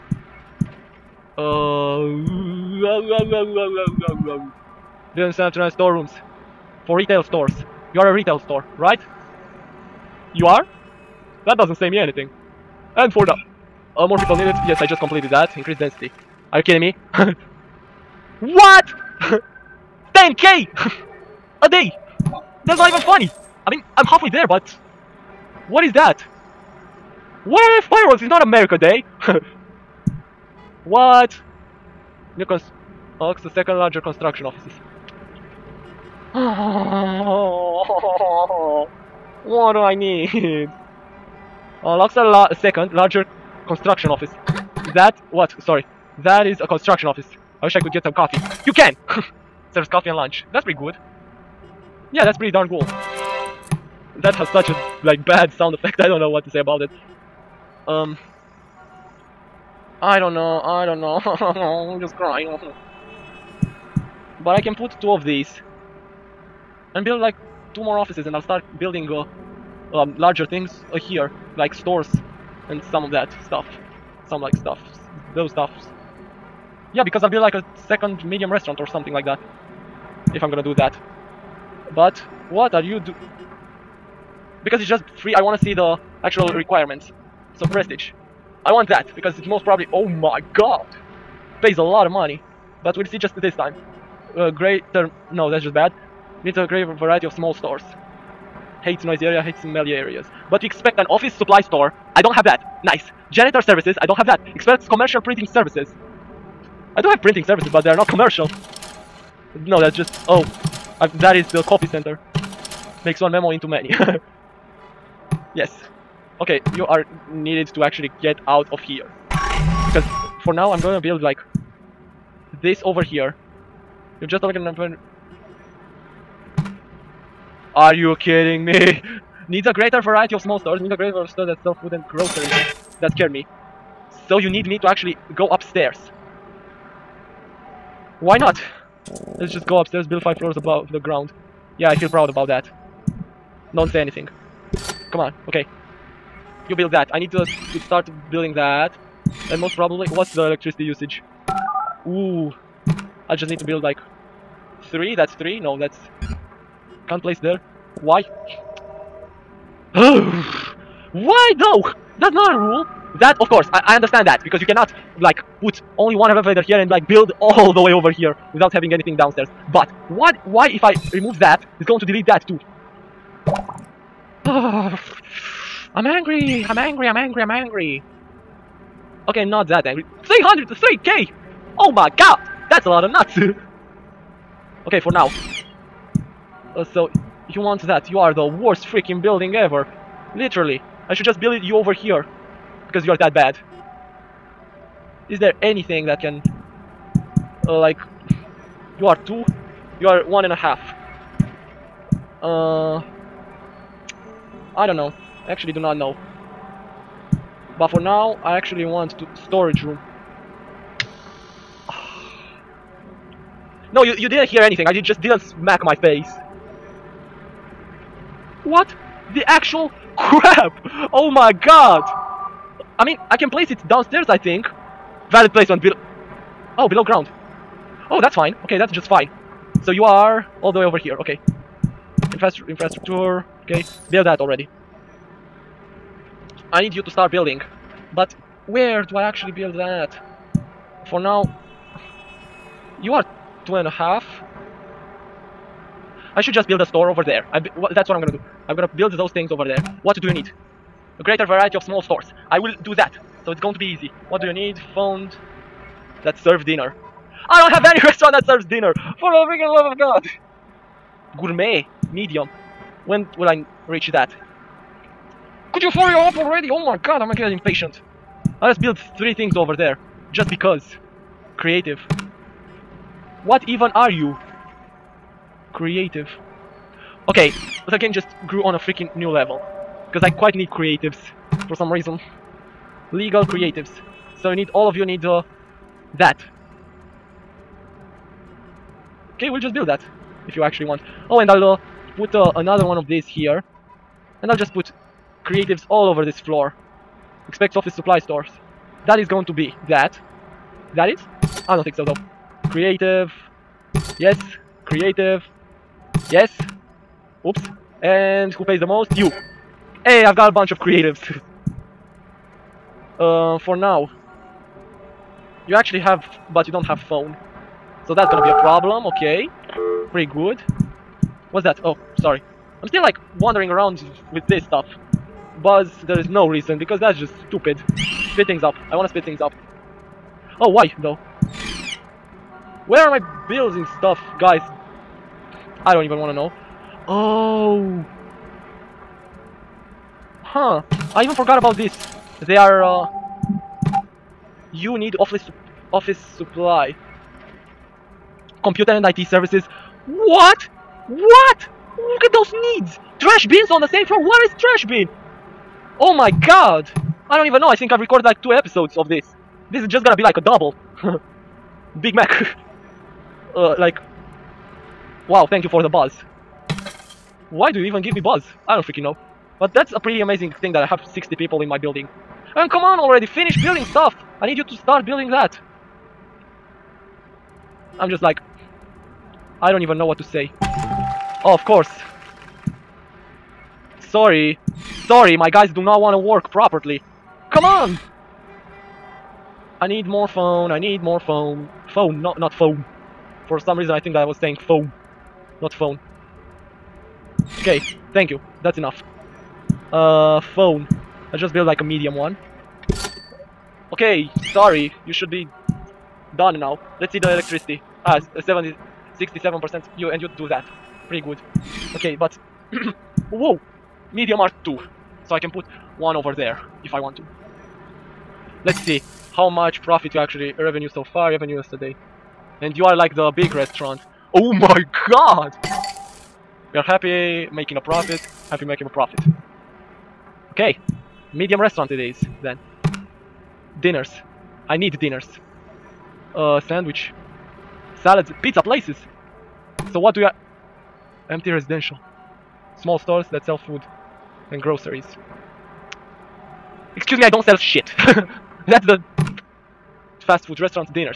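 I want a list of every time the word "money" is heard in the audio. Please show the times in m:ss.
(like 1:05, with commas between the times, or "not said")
1:32.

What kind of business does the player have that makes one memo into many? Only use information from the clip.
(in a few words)
copy center.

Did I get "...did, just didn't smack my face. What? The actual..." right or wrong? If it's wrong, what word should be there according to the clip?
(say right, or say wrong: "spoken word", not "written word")
right.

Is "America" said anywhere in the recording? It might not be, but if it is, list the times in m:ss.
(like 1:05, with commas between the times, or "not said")
0:28.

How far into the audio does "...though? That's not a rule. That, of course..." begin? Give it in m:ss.
2:41.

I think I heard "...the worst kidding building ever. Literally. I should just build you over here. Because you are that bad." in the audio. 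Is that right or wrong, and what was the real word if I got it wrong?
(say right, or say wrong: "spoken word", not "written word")
wrong: "freaking", not "kidding".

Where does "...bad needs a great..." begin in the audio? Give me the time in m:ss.
1:35.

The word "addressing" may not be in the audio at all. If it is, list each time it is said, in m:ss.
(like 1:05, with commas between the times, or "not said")
not said.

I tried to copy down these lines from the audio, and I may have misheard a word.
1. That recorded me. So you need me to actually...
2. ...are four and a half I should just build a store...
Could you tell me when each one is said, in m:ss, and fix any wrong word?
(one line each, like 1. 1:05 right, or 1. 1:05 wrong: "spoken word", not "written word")
1. 2:13 wrong: "scared", not "recorded"
2. 4:03 wrong: "two", not "four".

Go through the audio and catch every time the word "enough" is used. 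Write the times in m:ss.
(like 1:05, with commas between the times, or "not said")
6:38.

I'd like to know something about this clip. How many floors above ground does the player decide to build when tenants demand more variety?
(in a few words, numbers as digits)
5.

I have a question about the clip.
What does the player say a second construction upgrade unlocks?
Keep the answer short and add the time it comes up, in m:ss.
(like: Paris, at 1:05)
second larger construction office, at 0:33.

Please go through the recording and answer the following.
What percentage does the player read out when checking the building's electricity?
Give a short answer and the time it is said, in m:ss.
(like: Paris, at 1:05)
67%, at 6:49.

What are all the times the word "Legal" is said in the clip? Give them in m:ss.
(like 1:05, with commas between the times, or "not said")
4:43.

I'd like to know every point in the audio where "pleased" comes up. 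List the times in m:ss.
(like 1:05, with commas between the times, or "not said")
not said.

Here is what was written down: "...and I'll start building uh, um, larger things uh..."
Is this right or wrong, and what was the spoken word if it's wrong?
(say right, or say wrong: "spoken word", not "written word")
right.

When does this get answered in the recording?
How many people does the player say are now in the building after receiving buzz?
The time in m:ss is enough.
6:11.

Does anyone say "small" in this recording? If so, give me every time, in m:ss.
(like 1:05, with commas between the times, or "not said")
1:37, 2:10, 4:11, 7:22.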